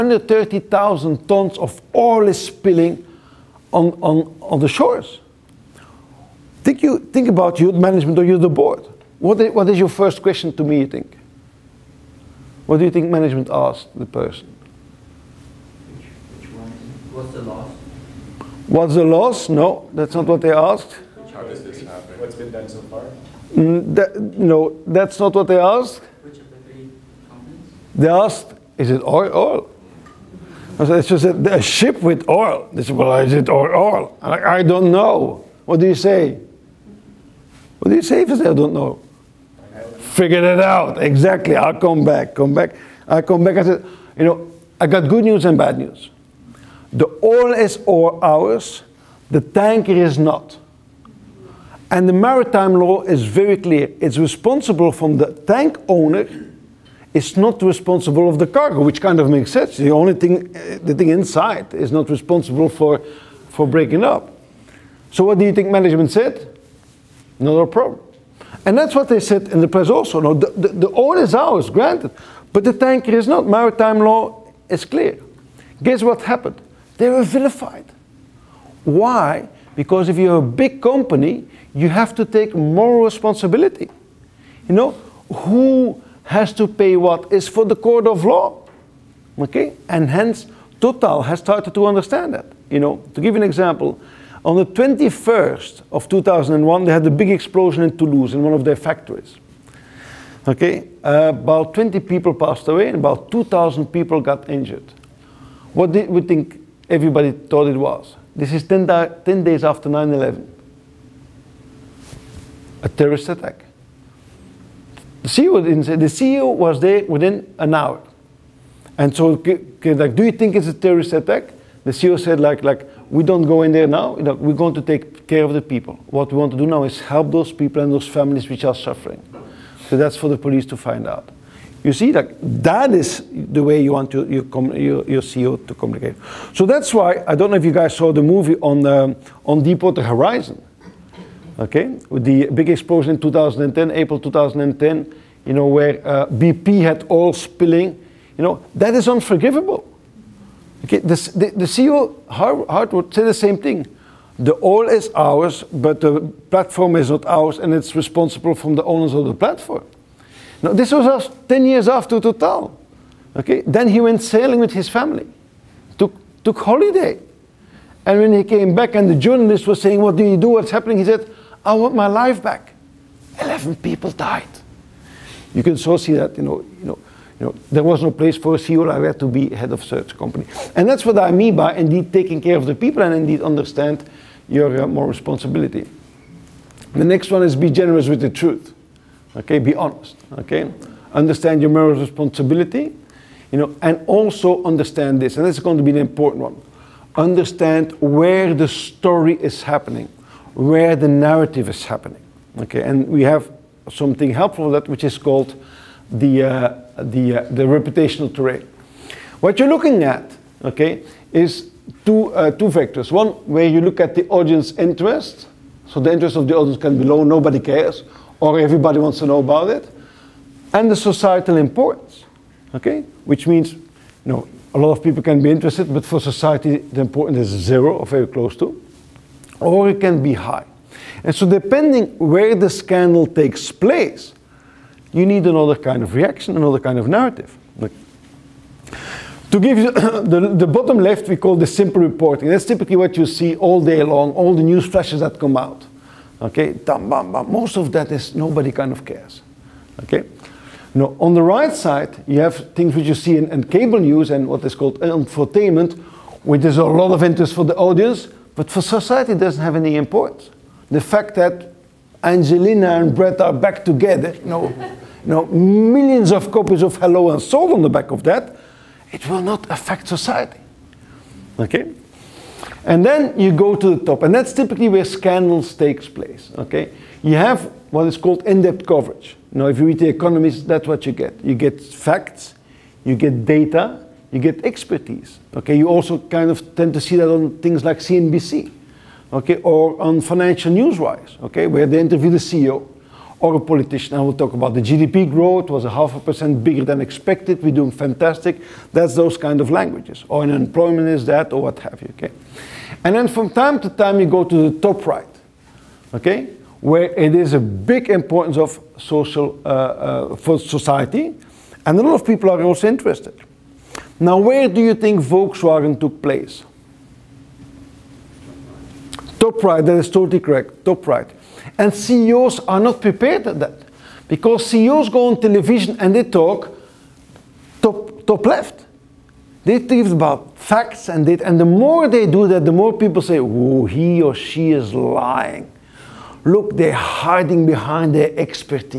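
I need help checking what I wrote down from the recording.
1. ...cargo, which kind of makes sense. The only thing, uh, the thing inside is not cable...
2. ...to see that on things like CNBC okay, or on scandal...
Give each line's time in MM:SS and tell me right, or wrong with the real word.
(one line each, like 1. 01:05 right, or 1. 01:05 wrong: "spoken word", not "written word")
1. 00:58 wrong: "responsible", not "cable"
2. 04:46 wrong: "financial", not "scandal".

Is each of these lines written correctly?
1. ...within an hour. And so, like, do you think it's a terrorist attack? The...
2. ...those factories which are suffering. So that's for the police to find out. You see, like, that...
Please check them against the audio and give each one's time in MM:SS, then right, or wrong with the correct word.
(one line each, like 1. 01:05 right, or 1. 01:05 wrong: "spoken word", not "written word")
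1. 01:57 right
2. 02:07 wrong: "families", not "factories".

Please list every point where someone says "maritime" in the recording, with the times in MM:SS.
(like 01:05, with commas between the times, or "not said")
00:52, 01:13.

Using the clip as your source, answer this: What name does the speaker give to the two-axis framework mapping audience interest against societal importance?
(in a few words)
Reputational terrain.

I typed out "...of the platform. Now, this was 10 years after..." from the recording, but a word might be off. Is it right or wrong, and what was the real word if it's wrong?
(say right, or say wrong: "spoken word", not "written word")
right.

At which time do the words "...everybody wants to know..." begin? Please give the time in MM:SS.
03:38.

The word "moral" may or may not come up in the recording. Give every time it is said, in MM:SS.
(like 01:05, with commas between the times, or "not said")
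01:22, 03:11.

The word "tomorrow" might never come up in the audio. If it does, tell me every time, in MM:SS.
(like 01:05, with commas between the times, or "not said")
not said.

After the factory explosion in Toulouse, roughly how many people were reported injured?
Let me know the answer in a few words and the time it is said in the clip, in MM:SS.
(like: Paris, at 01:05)
2,000, at 01:43.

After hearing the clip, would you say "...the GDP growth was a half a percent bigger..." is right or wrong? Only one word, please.
right.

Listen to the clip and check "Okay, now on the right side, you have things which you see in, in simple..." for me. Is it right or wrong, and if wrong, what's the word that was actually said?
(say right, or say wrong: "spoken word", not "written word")
wrong: "cable", not "simple".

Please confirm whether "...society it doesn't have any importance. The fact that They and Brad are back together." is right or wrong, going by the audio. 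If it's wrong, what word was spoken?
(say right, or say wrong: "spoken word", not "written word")
wrong: "Angelina", not "They".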